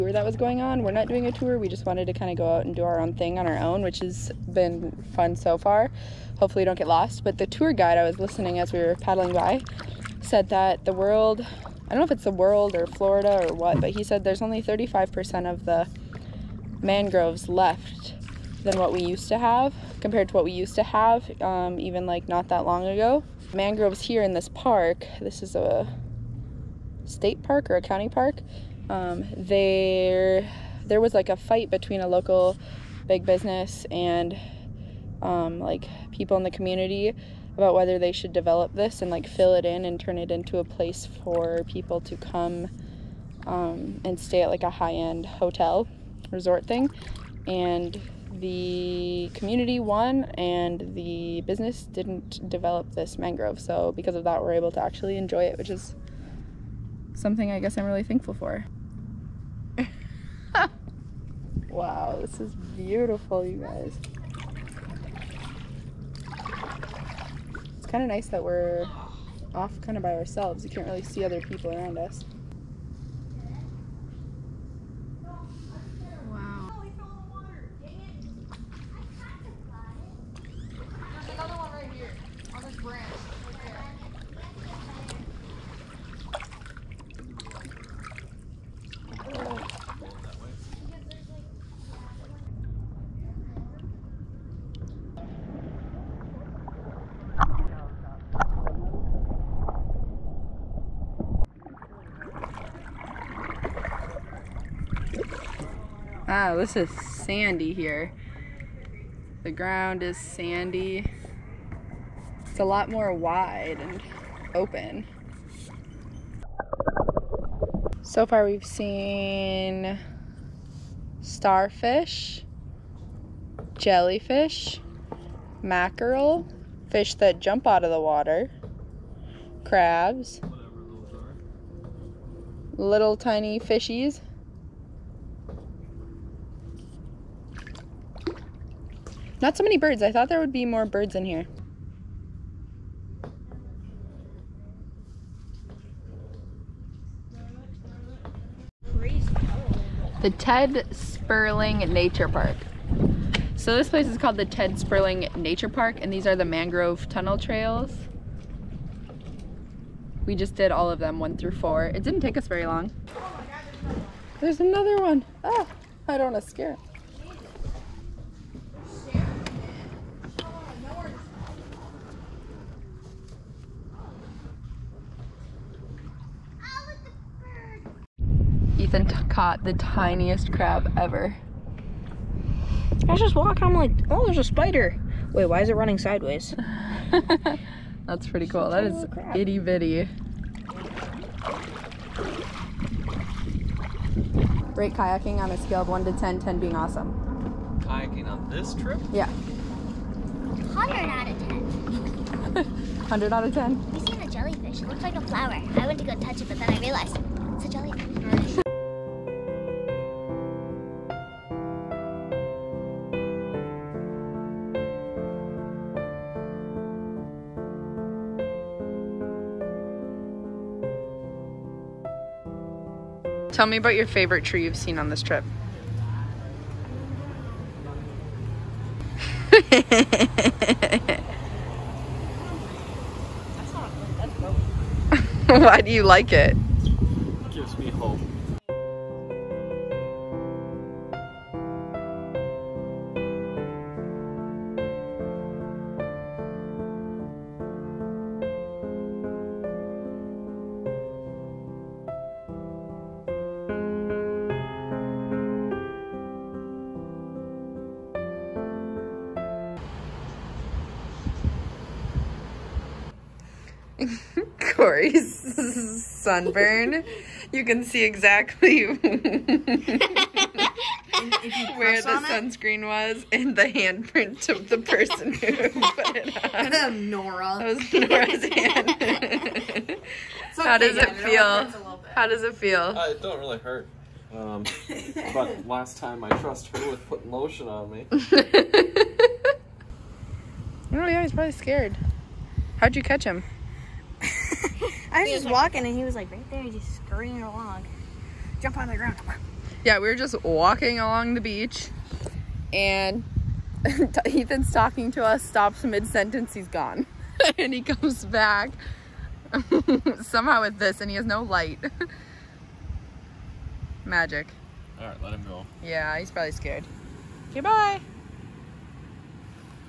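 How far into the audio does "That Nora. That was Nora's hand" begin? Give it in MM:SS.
04:36.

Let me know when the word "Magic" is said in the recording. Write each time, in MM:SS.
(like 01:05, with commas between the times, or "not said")
05:14.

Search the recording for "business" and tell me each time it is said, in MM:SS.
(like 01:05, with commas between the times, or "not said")
00:33, 00:51.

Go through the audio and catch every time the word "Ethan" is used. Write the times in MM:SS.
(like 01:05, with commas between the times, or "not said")
02:58, 05:04.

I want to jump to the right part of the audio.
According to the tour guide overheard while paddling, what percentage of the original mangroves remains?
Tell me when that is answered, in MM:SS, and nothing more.
00:14.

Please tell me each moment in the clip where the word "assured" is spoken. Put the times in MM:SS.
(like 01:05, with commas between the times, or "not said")
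not said.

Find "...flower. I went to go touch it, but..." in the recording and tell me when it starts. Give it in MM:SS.
03:25.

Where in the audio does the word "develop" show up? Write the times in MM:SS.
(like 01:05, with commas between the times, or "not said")
00:38, 00:52.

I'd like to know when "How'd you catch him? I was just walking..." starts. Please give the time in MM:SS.
04:52.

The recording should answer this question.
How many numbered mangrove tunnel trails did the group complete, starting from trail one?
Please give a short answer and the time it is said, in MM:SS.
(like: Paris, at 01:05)
4, at 02:41.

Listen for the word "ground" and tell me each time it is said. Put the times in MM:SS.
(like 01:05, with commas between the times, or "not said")
01:49, 04:58.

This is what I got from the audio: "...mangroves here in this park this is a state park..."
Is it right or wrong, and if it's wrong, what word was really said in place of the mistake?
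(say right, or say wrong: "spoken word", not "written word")
right.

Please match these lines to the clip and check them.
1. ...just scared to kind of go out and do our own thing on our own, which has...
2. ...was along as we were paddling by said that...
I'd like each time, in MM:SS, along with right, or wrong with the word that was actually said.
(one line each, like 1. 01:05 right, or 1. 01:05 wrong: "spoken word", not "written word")
1. 00:01 wrong: "wanted", not "scared"
2. 00:08 wrong: "listening", not "along".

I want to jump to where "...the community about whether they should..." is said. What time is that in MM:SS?
00:36.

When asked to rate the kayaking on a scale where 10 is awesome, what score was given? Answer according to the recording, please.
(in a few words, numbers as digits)
100 out of 10.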